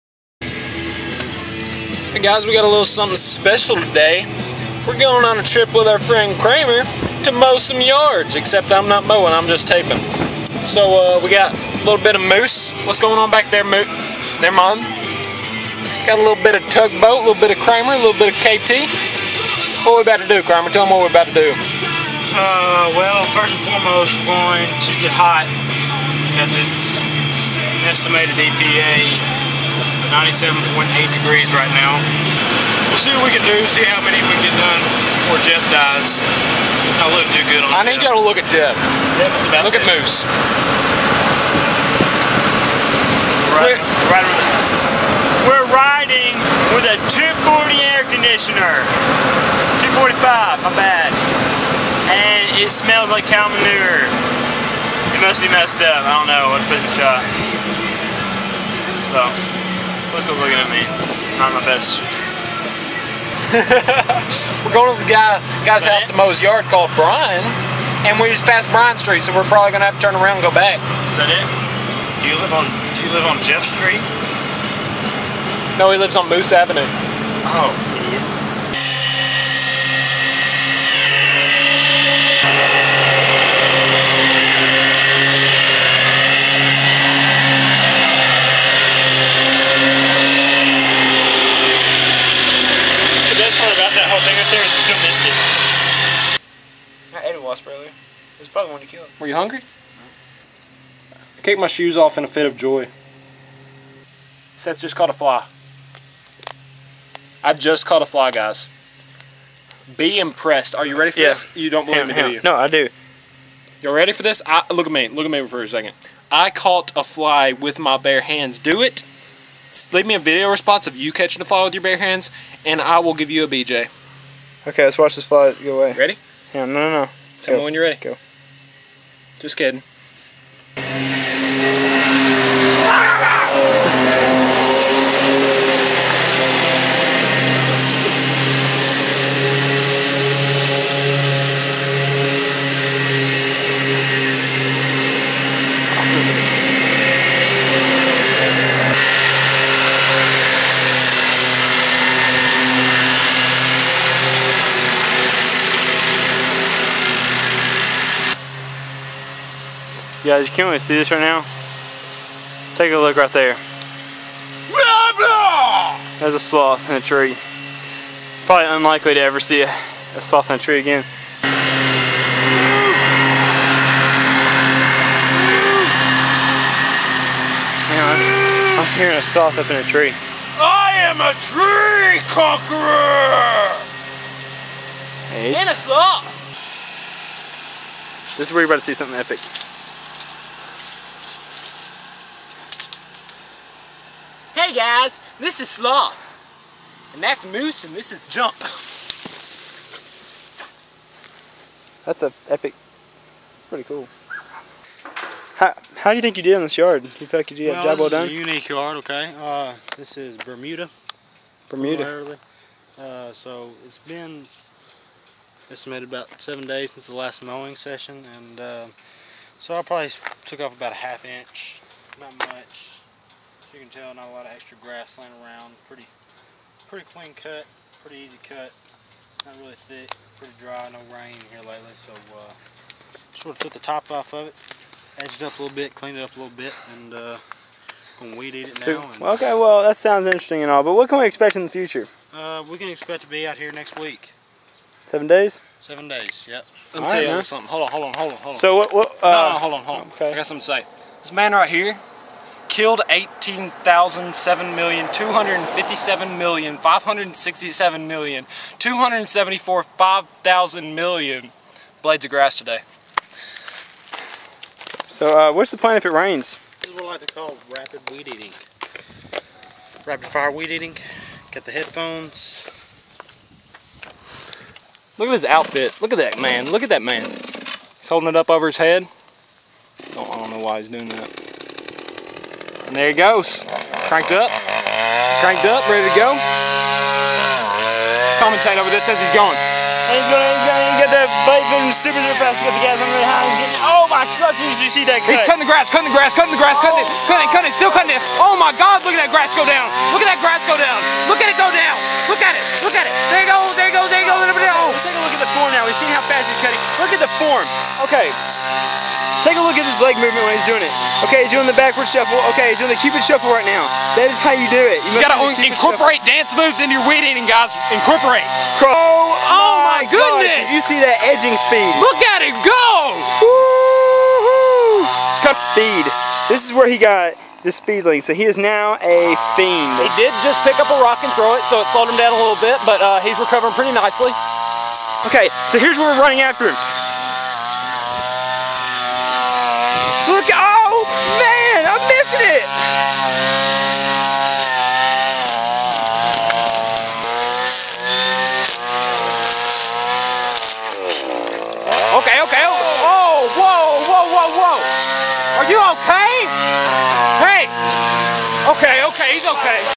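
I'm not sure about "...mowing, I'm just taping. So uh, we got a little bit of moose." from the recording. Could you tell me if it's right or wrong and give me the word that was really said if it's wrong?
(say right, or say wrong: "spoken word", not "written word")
right.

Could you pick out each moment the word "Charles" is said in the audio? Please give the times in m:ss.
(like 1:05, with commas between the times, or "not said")
not said.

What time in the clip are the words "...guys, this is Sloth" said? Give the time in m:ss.
3:14.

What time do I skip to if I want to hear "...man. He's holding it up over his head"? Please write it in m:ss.
4:37.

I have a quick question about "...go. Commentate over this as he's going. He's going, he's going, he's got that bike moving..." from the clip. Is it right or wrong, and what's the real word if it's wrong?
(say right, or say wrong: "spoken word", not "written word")
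right.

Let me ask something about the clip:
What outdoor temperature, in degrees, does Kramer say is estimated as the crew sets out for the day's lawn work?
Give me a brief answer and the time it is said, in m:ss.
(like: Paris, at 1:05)
97.8, at 0:30.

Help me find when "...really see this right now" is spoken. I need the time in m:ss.
2:40.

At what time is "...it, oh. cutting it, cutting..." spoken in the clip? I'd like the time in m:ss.
4:56.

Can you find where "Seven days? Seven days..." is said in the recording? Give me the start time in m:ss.
4:05.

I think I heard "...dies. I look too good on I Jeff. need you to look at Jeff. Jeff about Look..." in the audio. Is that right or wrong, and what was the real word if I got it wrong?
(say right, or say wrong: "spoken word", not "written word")
right.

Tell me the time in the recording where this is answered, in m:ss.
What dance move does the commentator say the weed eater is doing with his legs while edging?
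5:13.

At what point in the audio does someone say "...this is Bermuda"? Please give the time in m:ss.
3:29.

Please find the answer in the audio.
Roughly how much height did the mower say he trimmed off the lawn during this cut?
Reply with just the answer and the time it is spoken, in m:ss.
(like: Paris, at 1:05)
half inch, at 3:40.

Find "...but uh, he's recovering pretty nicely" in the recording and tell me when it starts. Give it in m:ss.
5:32.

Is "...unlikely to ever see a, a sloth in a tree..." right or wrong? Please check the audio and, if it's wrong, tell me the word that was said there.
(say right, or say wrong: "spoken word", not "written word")
right.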